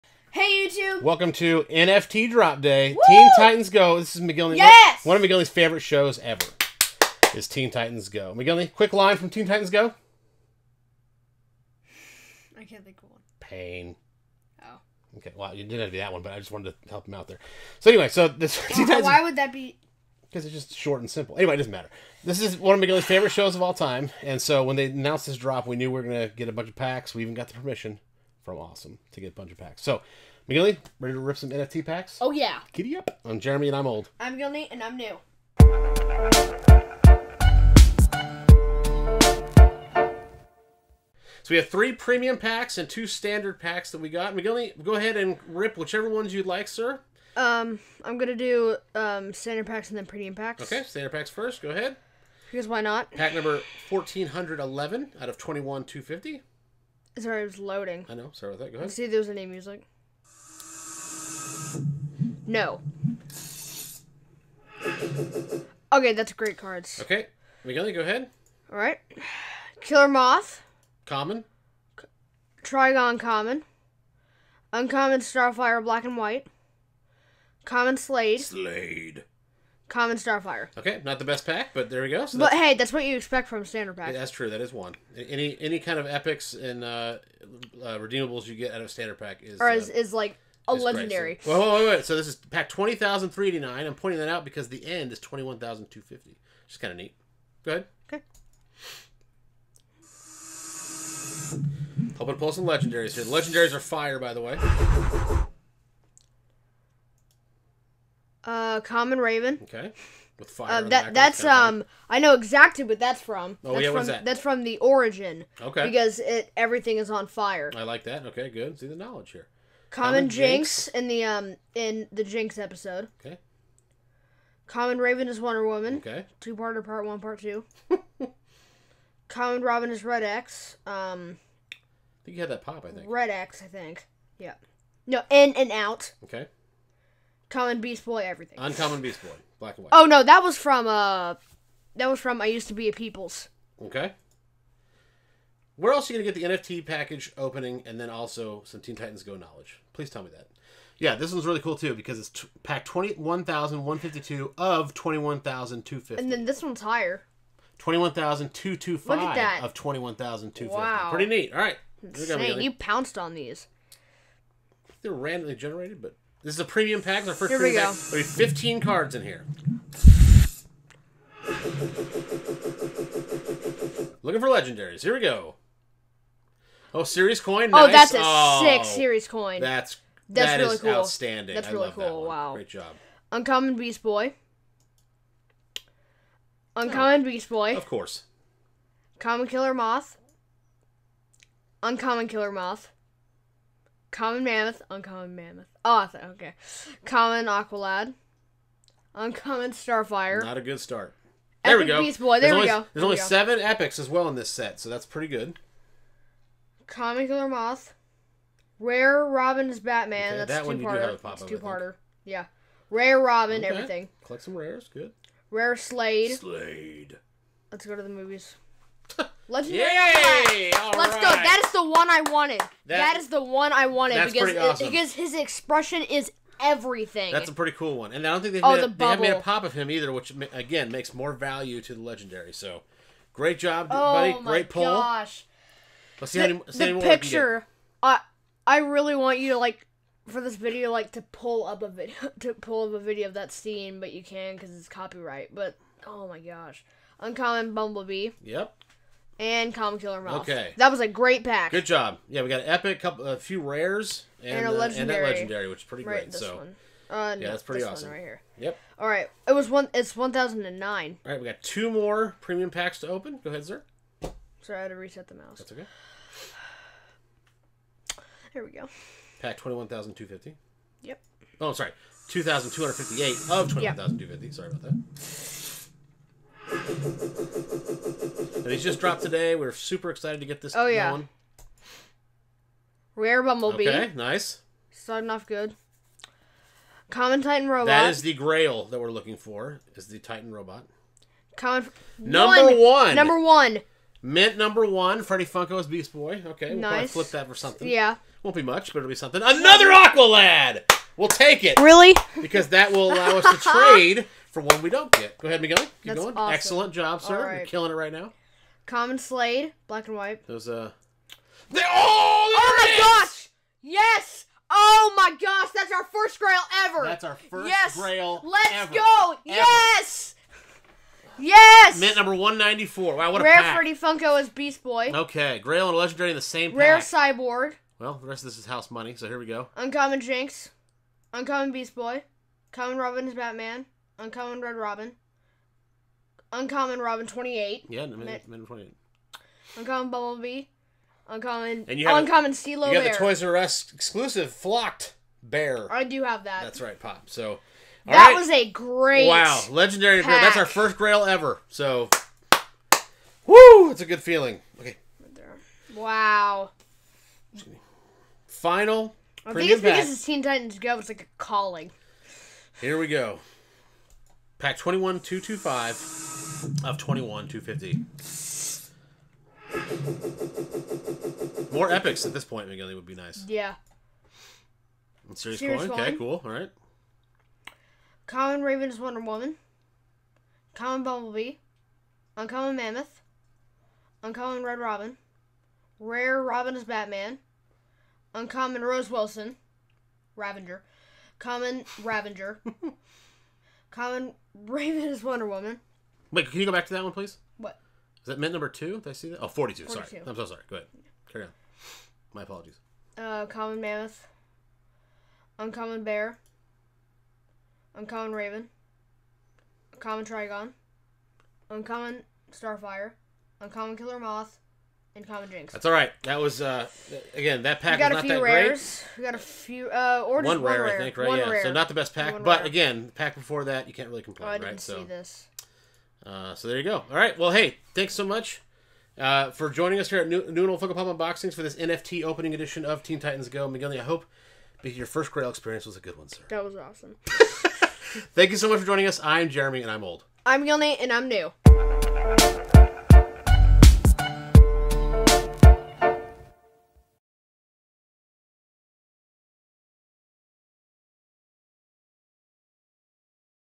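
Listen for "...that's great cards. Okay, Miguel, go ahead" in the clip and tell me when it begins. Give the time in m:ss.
1:06.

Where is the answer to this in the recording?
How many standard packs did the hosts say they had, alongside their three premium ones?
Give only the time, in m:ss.
0:42.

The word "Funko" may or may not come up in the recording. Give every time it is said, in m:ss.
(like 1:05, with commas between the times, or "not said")
4:55, 5:23, 7:10.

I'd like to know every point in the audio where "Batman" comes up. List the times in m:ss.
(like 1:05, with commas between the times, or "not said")
3:29, 5:33, 6:26.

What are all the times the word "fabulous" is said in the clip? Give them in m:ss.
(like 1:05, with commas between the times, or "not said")
not said.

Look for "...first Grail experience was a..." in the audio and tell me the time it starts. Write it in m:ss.
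7:15.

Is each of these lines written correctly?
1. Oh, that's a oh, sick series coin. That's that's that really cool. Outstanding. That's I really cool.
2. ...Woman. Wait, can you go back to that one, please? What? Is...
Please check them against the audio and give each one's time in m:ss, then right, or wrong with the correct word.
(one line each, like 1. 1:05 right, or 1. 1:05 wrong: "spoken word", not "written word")
1. 2:57 right
2. 6:35 right.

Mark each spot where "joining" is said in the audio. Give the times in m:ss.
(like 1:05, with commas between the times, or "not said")
7:09, 7:18.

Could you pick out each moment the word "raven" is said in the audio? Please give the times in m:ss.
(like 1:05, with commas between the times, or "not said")
1:49, 2:04, 6:18, 6:34, 6:48.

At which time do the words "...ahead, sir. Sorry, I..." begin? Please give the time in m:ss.
4:23.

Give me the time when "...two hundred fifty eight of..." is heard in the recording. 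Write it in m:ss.
4:32.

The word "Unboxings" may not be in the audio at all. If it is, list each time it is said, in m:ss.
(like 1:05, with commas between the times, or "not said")
7:11.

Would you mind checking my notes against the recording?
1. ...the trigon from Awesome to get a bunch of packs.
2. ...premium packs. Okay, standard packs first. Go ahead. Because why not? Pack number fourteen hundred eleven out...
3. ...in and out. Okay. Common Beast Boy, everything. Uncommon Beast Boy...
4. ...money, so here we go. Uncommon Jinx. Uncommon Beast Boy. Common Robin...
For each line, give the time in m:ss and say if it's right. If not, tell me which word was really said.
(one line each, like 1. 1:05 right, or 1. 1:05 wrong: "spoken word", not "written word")
1. 0:27 wrong: "permission", not "trigon"
2. 0:50 right
3. 2:15 right
4. 5:28 right.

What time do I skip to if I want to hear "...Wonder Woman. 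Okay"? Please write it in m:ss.
2:05.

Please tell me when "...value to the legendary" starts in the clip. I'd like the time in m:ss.
3:51.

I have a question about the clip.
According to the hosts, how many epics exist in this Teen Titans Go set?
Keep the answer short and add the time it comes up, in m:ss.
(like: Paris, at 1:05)
7, at 3:23.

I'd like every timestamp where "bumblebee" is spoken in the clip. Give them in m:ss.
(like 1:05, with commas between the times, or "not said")
4:07, 4:43, 5:40, 6:21.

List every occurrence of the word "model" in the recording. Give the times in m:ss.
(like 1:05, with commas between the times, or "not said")
not said.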